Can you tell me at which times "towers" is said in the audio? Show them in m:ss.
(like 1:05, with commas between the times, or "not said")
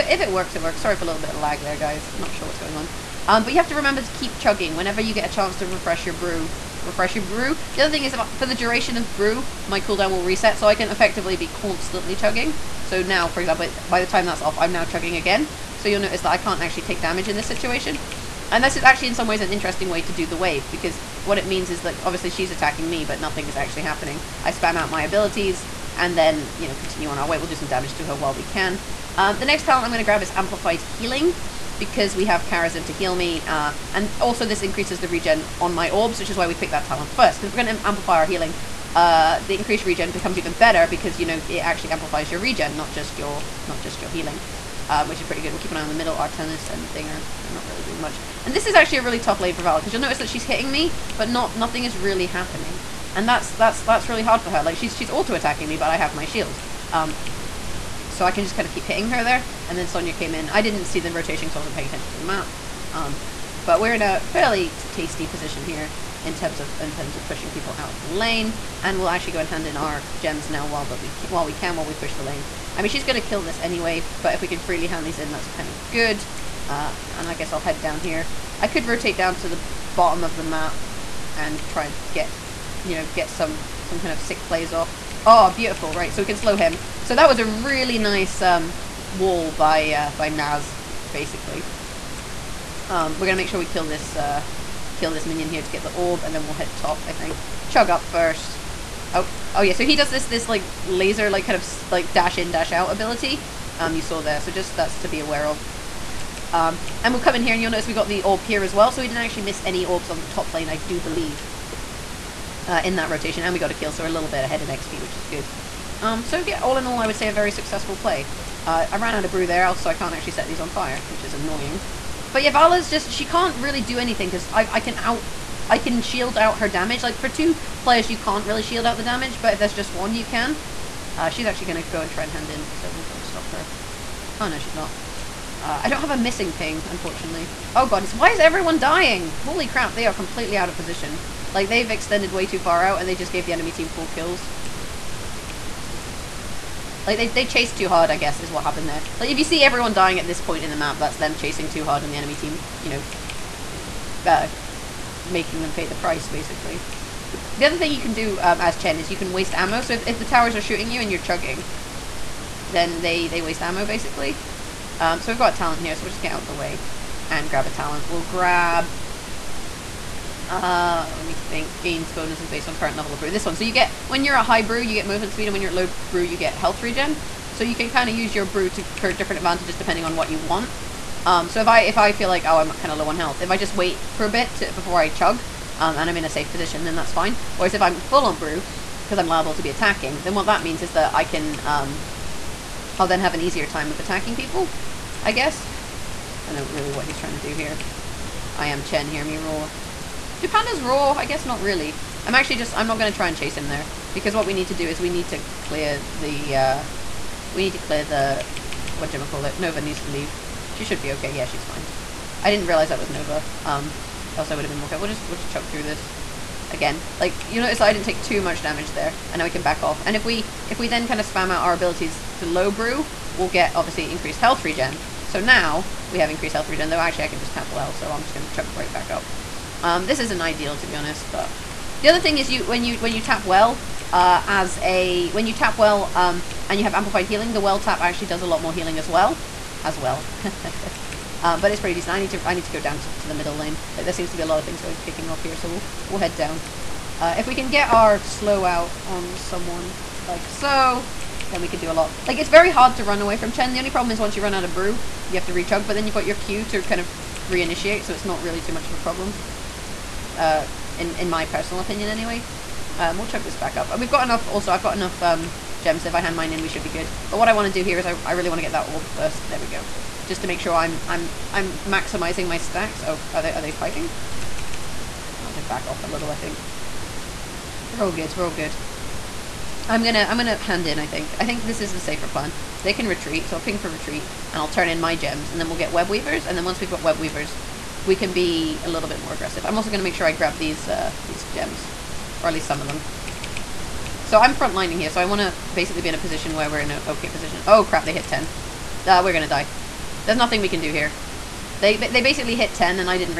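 2:40.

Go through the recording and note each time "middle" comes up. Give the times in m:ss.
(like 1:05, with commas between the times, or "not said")
0:45, 4:03.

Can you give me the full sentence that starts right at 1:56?
Um, so yeah, all in all, I would say a very successful play.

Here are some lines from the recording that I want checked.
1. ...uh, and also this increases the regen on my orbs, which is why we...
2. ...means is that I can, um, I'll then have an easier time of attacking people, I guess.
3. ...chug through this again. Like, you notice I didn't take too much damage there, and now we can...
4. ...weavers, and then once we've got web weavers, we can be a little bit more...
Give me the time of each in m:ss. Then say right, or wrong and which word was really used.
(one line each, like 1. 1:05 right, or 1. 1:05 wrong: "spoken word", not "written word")
1. 0:33 right
2. 3:10 right
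3. 3:35 right
4. 4:46 right.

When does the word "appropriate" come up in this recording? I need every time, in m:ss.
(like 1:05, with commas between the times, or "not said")
not said.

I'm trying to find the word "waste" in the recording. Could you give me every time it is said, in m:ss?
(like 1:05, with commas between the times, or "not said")
2:39, 2:43.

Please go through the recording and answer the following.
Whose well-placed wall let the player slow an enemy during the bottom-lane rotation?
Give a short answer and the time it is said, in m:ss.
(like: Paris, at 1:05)
Naz, at 1:30.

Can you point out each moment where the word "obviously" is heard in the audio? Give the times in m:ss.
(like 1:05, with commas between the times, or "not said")
0:22, 3:43.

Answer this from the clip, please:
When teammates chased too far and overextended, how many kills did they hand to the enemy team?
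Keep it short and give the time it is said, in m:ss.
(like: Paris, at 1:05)
4, at 2:23.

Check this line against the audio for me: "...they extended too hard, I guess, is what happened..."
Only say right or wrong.
wrong.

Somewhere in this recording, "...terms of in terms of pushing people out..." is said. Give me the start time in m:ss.
1:06.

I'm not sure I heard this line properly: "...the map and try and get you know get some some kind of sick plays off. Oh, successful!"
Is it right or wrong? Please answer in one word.
wrong.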